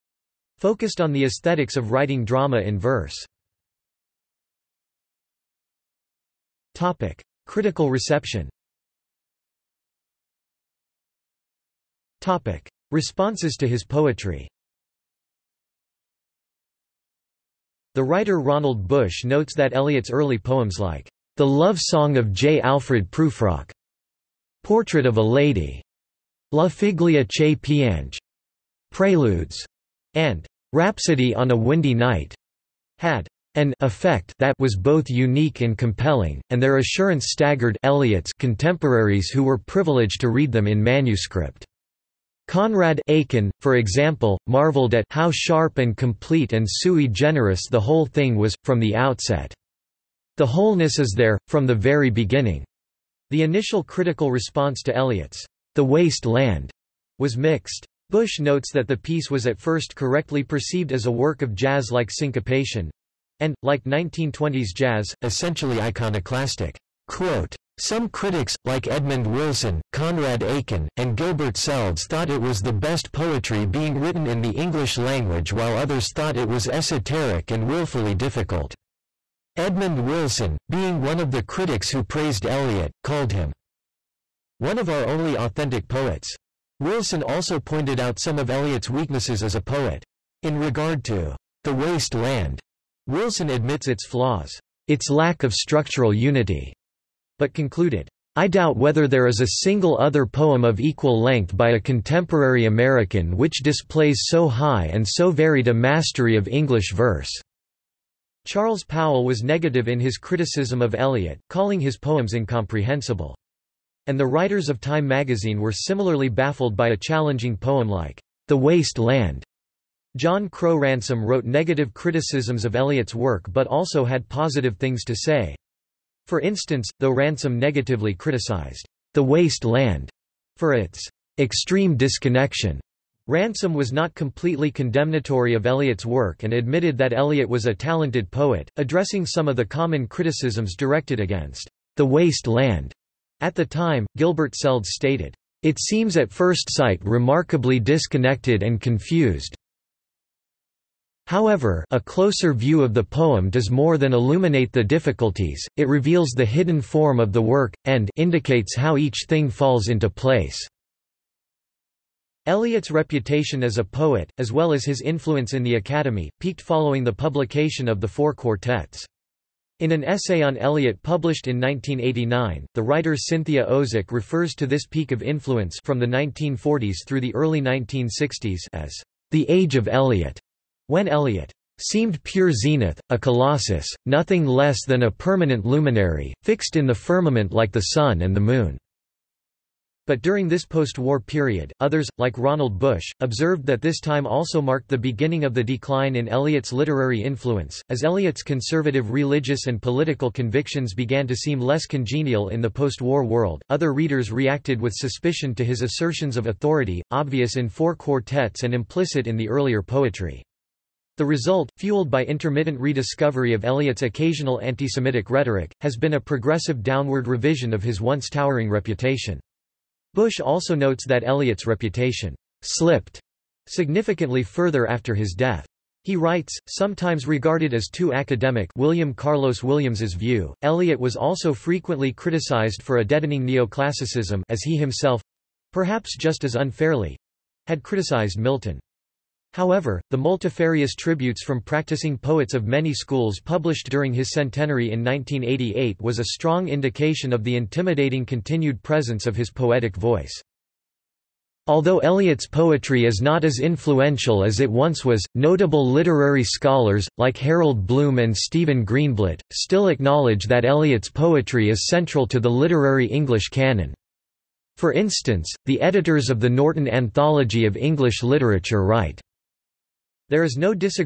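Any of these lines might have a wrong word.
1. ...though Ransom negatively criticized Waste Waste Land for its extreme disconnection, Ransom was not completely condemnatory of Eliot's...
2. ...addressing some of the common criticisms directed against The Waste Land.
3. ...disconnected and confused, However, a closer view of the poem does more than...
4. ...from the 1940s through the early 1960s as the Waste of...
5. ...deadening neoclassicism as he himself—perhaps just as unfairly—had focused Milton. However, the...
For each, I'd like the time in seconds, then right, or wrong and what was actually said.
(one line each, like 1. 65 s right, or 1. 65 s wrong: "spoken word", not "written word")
1. 126 s wrong: "The", not "Waste"
2. 138 s right
3. 147 s right
4. 175 s wrong: "Age", not "Waste"
5. 233 s wrong: "criticized", not "focused".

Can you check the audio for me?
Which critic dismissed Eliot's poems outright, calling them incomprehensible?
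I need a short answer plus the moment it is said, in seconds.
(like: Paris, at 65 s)
Charles Powell, at 108 s.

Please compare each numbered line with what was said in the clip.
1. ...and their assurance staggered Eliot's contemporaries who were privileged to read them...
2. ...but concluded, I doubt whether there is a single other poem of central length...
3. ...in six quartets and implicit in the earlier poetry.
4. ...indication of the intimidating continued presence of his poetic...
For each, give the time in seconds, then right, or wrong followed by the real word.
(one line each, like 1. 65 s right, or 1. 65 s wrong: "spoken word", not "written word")
1. 36 s right
2. 97 s wrong: "equal", not "central"
3. 207 s wrong: "four", not "six"
4. 246 s right.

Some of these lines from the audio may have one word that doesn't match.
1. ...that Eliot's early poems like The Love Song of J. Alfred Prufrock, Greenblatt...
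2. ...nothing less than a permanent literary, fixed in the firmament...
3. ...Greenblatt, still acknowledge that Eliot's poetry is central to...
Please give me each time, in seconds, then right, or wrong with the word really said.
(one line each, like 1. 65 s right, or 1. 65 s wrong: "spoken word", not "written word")
1. 19 s wrong: "Portrait", not "Greenblatt"
2. 184 s wrong: "luminary", not "literary"
3. 258 s right.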